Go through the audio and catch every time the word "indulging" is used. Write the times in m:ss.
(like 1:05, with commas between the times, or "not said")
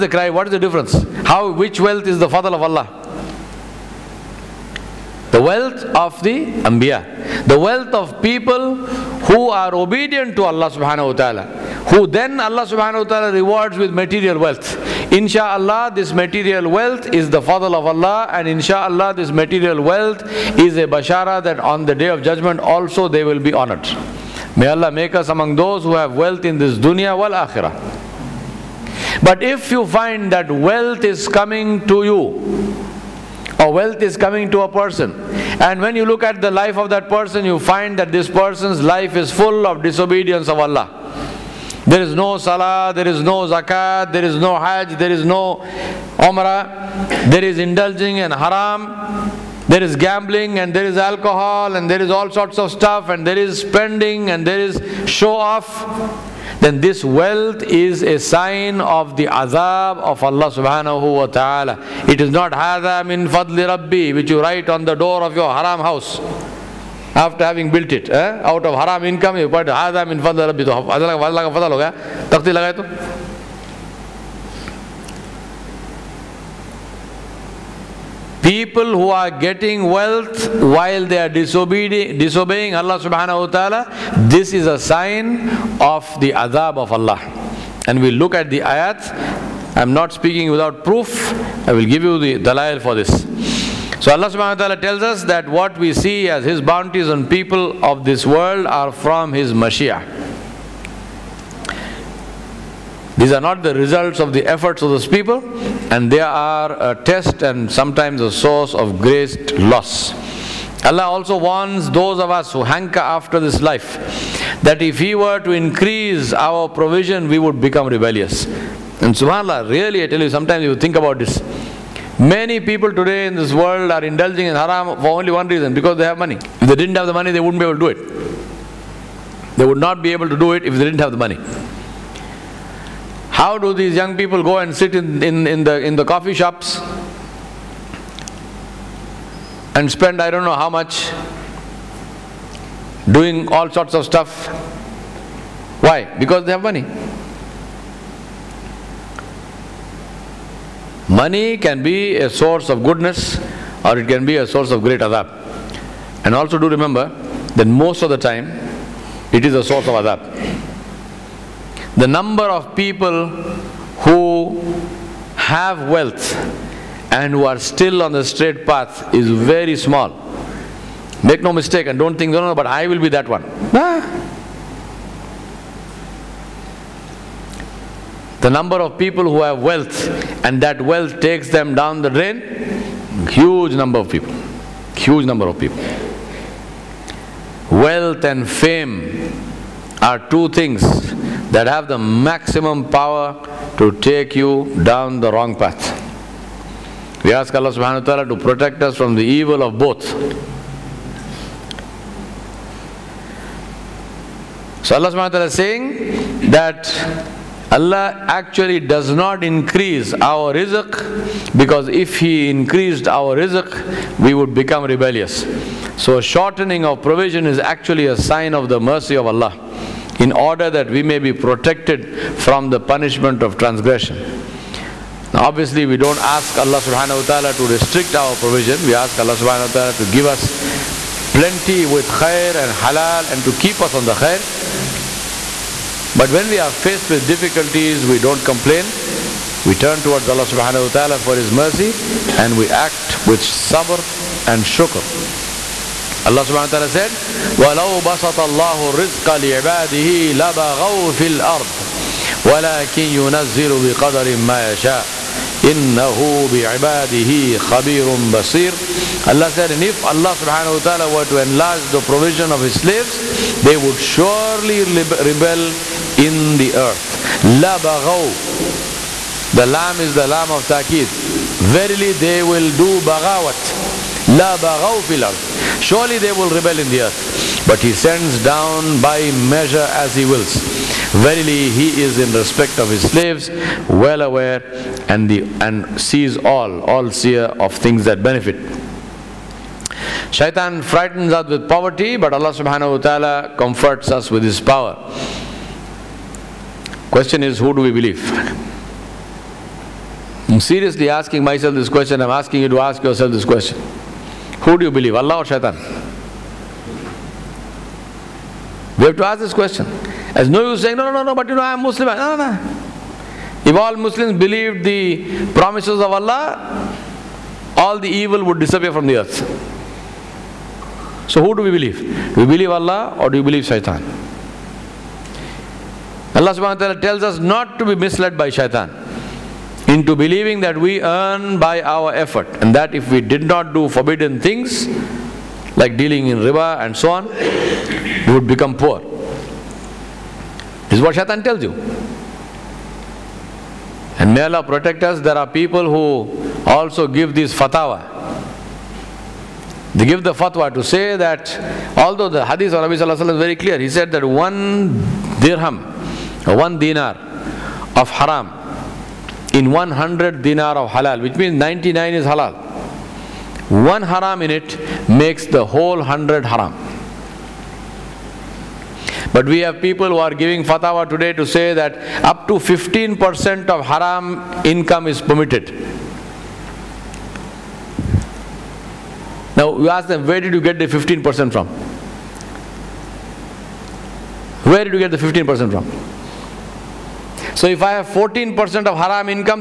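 0:47, 2:04.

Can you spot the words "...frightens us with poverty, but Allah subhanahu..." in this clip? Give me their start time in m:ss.
4:50.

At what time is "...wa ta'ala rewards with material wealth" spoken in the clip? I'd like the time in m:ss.
0:13.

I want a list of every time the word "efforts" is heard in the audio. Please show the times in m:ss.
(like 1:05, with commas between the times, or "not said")
1:44, 5:32.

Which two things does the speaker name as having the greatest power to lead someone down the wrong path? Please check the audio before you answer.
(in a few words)
Wealth and fame.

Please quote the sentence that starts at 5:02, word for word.
I'm asking you to ask yourself this question.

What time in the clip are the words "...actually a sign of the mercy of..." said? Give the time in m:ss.
3:37.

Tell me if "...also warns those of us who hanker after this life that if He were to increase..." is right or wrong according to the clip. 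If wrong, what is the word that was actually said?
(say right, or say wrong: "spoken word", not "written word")
right.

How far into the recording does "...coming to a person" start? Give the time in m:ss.
0:34.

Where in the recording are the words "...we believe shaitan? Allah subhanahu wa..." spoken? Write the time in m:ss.
5:23.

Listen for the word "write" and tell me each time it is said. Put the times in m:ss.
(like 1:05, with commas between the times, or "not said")
1:04.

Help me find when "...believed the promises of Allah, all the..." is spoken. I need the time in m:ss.
5:14.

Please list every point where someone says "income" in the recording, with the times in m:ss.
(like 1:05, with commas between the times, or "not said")
1:09, 6:14.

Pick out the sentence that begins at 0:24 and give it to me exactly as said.
May Allah make us among those who have wealth in this dunya wal akhirah.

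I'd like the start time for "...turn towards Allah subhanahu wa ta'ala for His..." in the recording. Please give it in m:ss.
3:59.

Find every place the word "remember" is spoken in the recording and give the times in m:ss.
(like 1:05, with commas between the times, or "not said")
2:36.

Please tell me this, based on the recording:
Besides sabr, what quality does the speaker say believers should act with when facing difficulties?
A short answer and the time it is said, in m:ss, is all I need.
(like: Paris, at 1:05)
shukr, at 4:04.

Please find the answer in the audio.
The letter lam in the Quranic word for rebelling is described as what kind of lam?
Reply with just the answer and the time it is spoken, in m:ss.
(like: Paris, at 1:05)
taqid, at 4:30.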